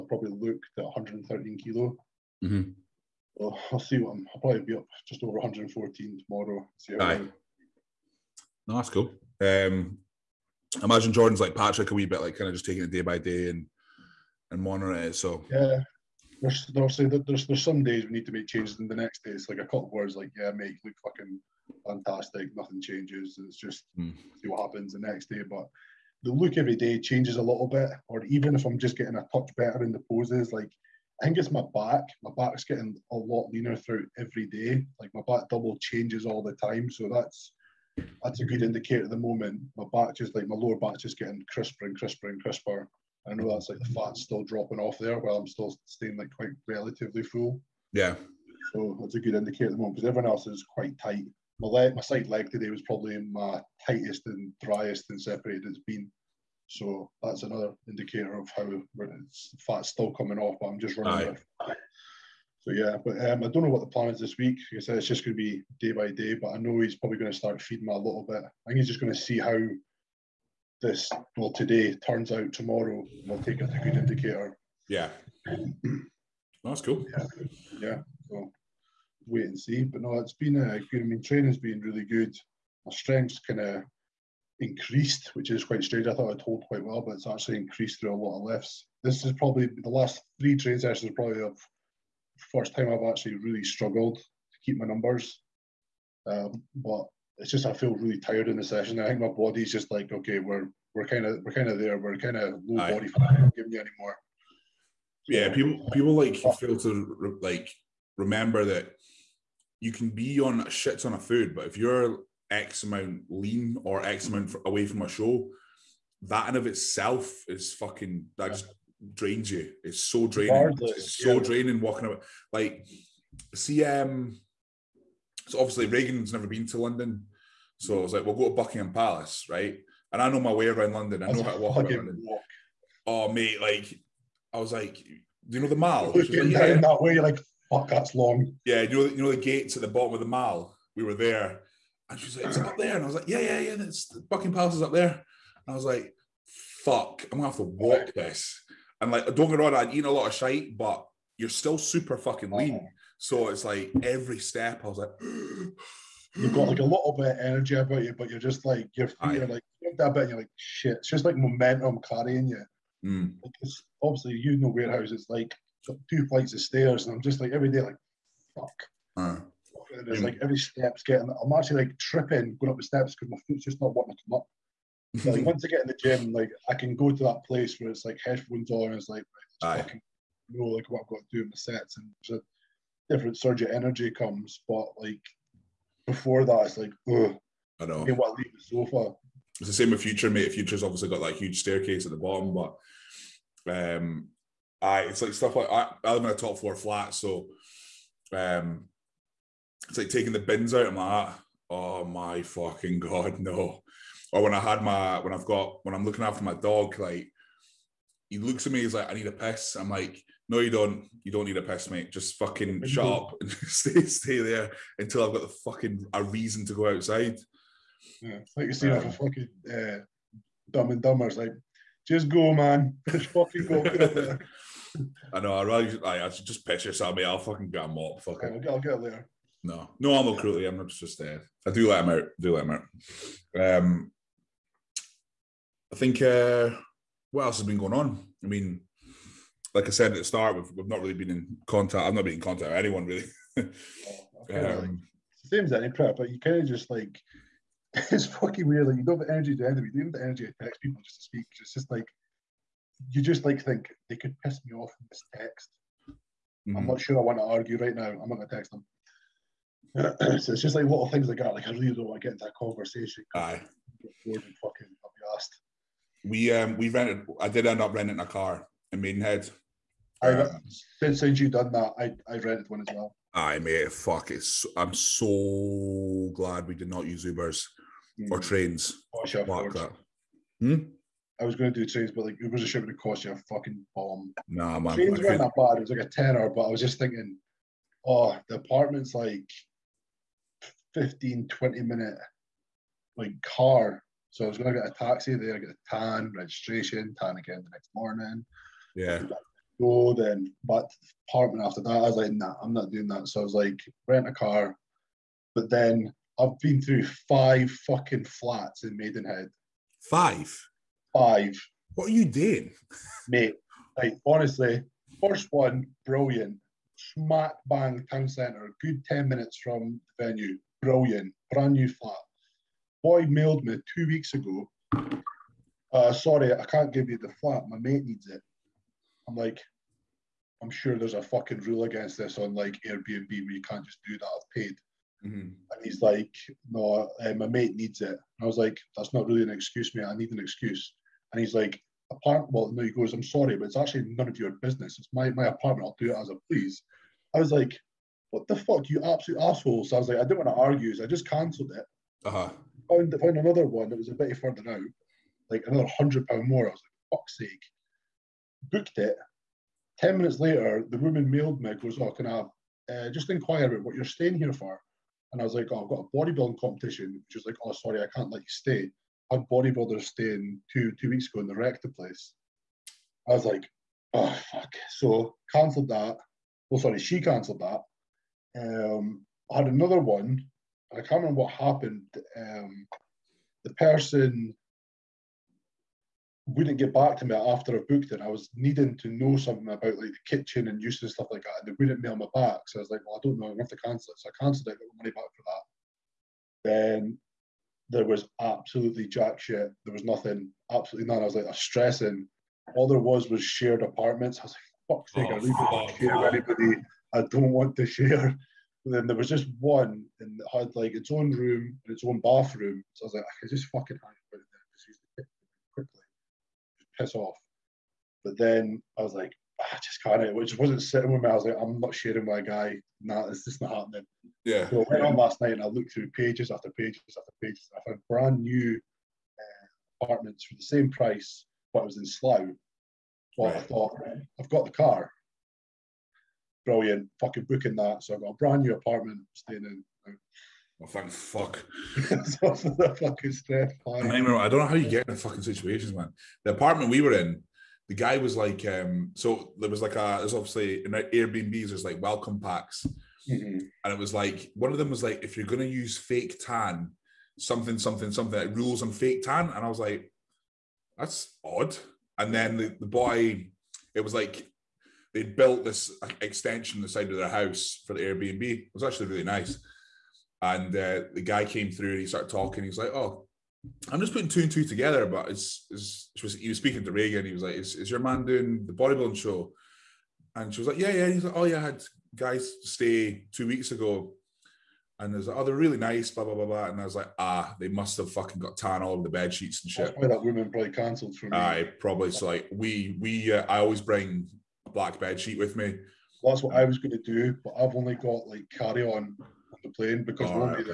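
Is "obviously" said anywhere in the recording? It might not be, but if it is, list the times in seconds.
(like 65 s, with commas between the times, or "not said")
16 s, 125 s, 164 s, 190 s, 450 s.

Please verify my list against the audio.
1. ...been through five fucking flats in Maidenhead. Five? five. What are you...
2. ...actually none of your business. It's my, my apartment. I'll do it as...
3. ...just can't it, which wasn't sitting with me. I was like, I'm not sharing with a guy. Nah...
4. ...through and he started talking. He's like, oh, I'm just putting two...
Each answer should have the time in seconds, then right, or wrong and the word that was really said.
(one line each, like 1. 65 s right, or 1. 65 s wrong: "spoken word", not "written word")
1. 306 s right
2. 343 s right
3. 419 s right
4. 471 s right.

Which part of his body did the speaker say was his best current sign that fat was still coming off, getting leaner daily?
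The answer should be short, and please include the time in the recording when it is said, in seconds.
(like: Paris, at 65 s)
lower back, at 40 s.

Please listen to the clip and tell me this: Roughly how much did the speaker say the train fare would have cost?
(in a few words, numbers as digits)
a tenner.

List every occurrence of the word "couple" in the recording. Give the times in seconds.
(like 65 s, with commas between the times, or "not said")
19 s.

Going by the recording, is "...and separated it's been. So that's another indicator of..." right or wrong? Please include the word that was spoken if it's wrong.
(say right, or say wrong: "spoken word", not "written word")
right.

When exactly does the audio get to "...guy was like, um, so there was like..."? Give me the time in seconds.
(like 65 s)
447 s.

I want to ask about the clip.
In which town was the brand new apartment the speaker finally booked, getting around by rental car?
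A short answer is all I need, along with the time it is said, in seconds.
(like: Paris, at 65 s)
Slough, at 432 s.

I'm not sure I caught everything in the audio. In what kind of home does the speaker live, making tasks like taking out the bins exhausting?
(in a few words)
top floor flat.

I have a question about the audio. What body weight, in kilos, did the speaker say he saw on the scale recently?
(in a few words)
113.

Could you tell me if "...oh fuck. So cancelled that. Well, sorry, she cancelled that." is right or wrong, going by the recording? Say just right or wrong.
right.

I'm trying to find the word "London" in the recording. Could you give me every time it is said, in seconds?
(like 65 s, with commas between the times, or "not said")
126 s, 130 s.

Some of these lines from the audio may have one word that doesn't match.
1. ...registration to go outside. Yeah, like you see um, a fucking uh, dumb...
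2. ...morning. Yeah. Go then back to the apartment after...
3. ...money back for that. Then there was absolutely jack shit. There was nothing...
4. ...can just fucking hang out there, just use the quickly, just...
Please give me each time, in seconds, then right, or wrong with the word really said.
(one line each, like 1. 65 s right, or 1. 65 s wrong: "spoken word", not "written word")
1. 216 s wrong: "reason", not "registration"
2. 297 s right
3. 394 s right
4. 413 s right.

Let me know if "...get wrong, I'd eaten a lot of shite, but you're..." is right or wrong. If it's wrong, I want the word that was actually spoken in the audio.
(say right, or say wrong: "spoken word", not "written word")
right.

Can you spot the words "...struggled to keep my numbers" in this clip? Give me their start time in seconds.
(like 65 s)
93 s.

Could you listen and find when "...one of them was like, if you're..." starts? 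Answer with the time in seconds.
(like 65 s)
454 s.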